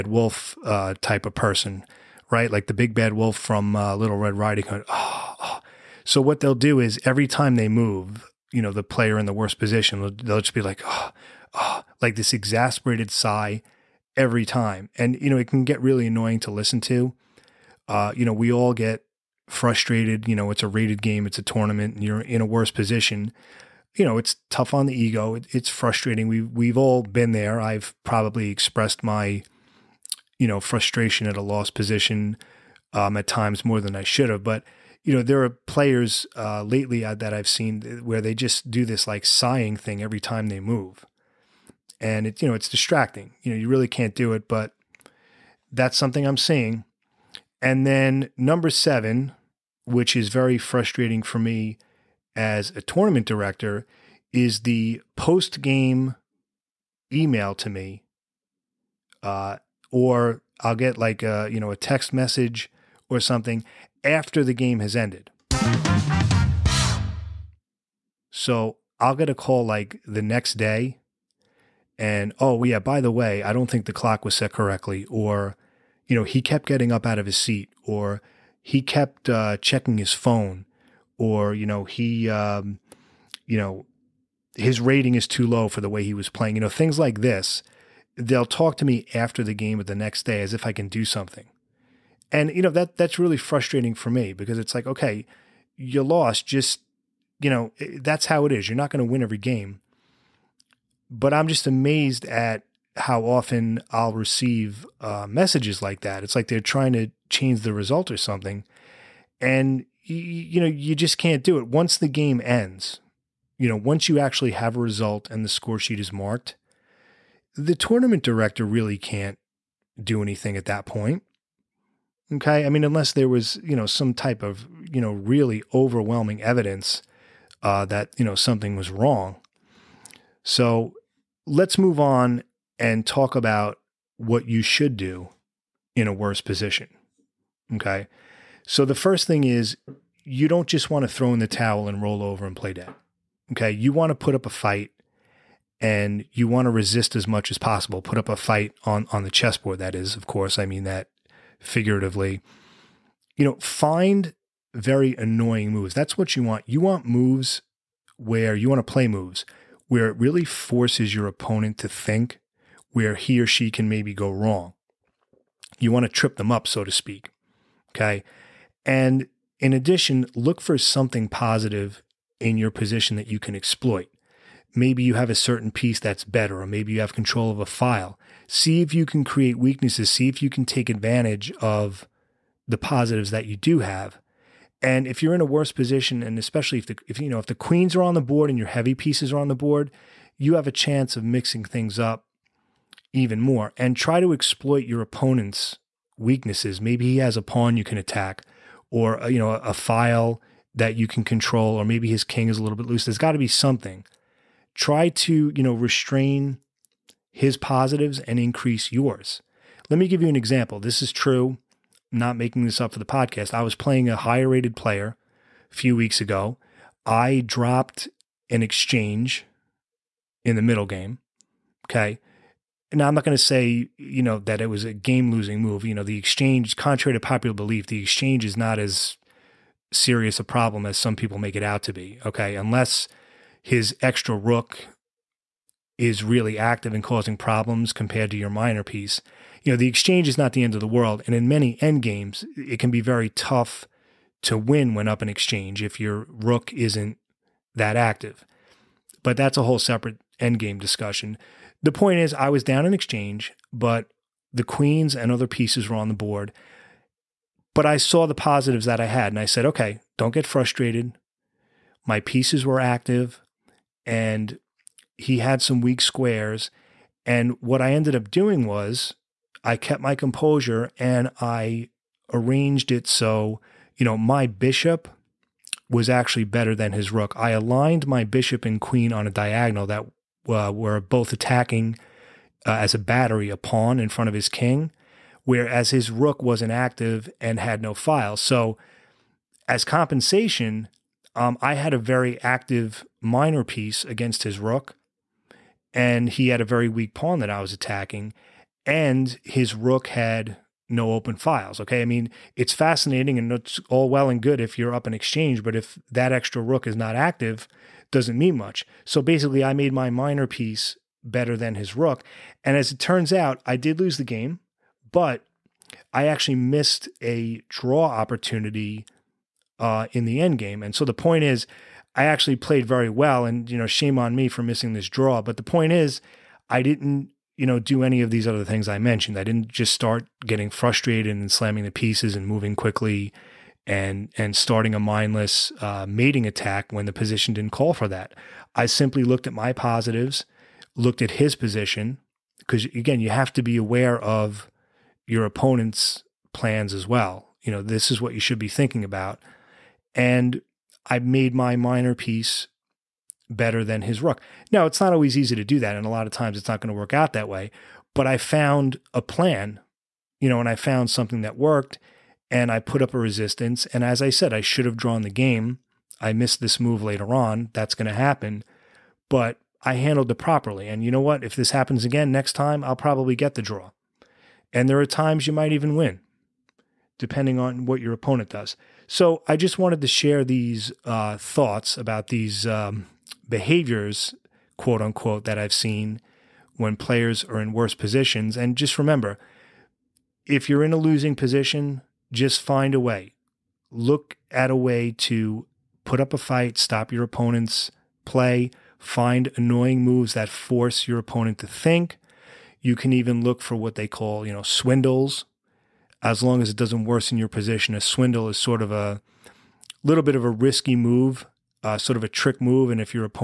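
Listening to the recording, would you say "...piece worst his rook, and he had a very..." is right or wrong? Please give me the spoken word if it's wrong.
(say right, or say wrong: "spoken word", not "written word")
wrong: "against", not "worst".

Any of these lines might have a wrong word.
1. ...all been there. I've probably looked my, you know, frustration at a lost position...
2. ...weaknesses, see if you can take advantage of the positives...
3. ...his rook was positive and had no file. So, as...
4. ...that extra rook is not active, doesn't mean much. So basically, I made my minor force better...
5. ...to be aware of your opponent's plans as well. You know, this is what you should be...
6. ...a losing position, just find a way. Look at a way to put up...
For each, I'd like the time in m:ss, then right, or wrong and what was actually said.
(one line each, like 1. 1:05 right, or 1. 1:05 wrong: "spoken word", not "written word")
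1. 0:26 wrong: "expressed", not "looked"
2. 2:59 right
3. 4:45 wrong: "inactive", not "positive"
4. 5:06 wrong: "piece", not "force"
5. 5:43 right
6. 6:30 right.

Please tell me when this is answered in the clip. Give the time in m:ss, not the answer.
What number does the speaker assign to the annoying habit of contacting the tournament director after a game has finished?
0:48.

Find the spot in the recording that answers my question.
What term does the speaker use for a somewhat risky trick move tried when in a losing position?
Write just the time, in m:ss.
6:44.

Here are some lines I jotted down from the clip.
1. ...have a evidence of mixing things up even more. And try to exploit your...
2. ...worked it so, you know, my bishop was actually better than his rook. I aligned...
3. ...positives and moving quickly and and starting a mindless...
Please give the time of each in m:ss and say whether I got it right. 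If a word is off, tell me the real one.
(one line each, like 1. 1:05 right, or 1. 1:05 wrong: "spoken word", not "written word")
1. 3:10 wrong: "chance", not "evidence"
2. 4:32 wrong: "arranged", not "worked"
3. 5:31 wrong: "pieces", not "positives".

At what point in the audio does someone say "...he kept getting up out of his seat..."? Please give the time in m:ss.
1:16.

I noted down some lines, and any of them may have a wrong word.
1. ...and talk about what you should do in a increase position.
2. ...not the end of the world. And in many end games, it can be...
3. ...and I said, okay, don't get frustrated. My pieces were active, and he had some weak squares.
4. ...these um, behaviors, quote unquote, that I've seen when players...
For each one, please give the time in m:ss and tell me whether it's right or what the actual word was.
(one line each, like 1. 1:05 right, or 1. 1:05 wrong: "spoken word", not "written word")
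1. 2:12 wrong: "worse", not "increase"
2. 4:00 right
3. 4:19 right
4. 6:22 right.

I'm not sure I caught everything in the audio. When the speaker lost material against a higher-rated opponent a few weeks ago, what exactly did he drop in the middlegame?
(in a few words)
an exchange.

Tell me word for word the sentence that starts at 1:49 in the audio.
And you, you know, you just can't do it.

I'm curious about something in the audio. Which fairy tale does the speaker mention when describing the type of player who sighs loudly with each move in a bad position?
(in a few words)
Little Red Riding Hood.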